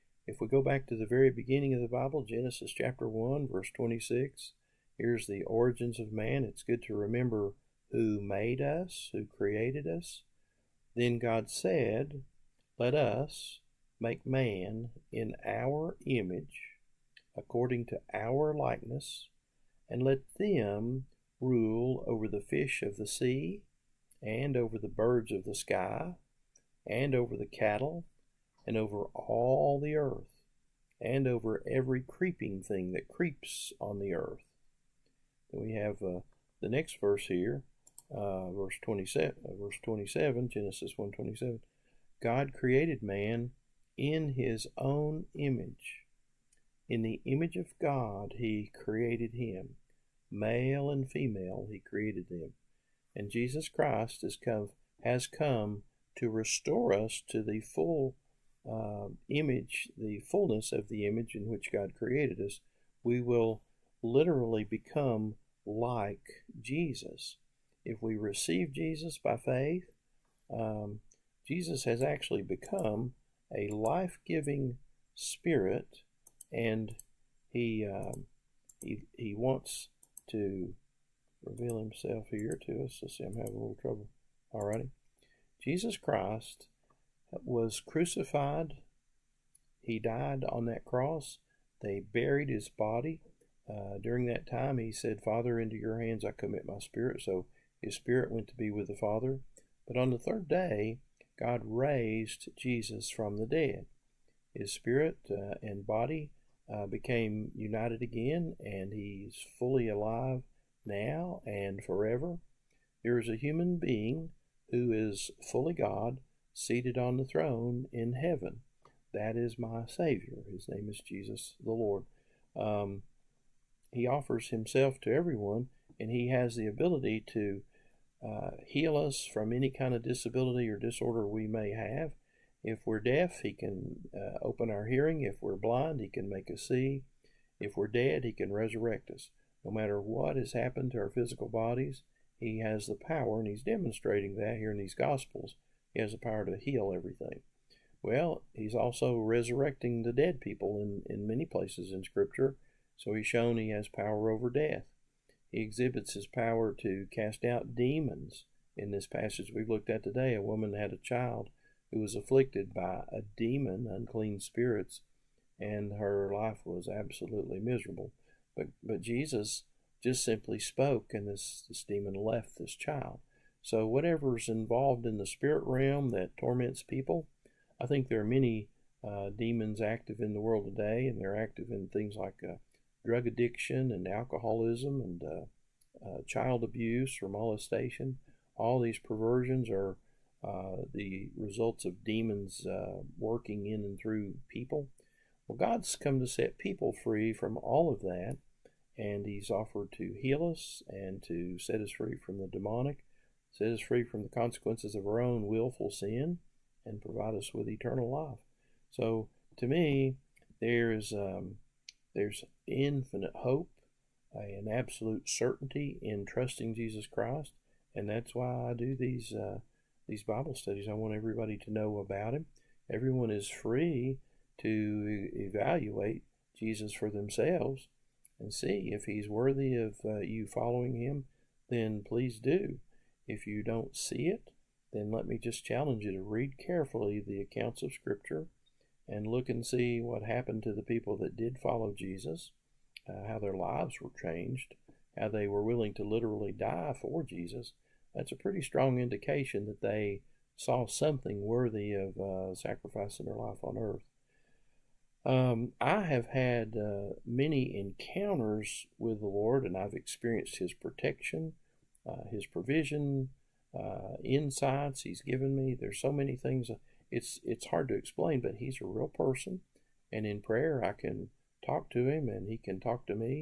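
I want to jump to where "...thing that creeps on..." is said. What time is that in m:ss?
0:32.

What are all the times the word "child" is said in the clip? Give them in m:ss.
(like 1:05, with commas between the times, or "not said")
2:40, 2:52, 3:06.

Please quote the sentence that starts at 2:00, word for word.
His name is Jesus the Lord.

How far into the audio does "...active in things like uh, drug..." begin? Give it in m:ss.
3:01.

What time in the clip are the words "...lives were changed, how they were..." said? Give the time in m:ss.
4:03.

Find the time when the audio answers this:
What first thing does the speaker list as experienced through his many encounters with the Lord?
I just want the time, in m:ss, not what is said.
4:20.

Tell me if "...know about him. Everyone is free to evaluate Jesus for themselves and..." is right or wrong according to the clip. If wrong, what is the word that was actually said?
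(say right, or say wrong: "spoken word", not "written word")
right.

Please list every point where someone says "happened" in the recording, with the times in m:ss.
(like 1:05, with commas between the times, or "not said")
2:20, 4:00.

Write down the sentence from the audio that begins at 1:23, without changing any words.
Let's see, I'm having a little trouble.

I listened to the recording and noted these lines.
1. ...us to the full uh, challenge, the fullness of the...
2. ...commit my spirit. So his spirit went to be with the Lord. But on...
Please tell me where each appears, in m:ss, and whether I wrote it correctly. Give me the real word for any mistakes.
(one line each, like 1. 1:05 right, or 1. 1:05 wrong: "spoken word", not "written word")
1. 0:56 wrong: "image", not "challenge"
2. 1:36 wrong: "Father", not "Lord".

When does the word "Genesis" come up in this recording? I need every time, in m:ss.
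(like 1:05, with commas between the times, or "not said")
0:02, 0:40.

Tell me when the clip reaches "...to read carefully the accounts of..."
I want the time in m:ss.
3:56.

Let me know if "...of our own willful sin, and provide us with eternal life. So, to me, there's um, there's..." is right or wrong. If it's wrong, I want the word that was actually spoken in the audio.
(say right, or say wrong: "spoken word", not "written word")
right.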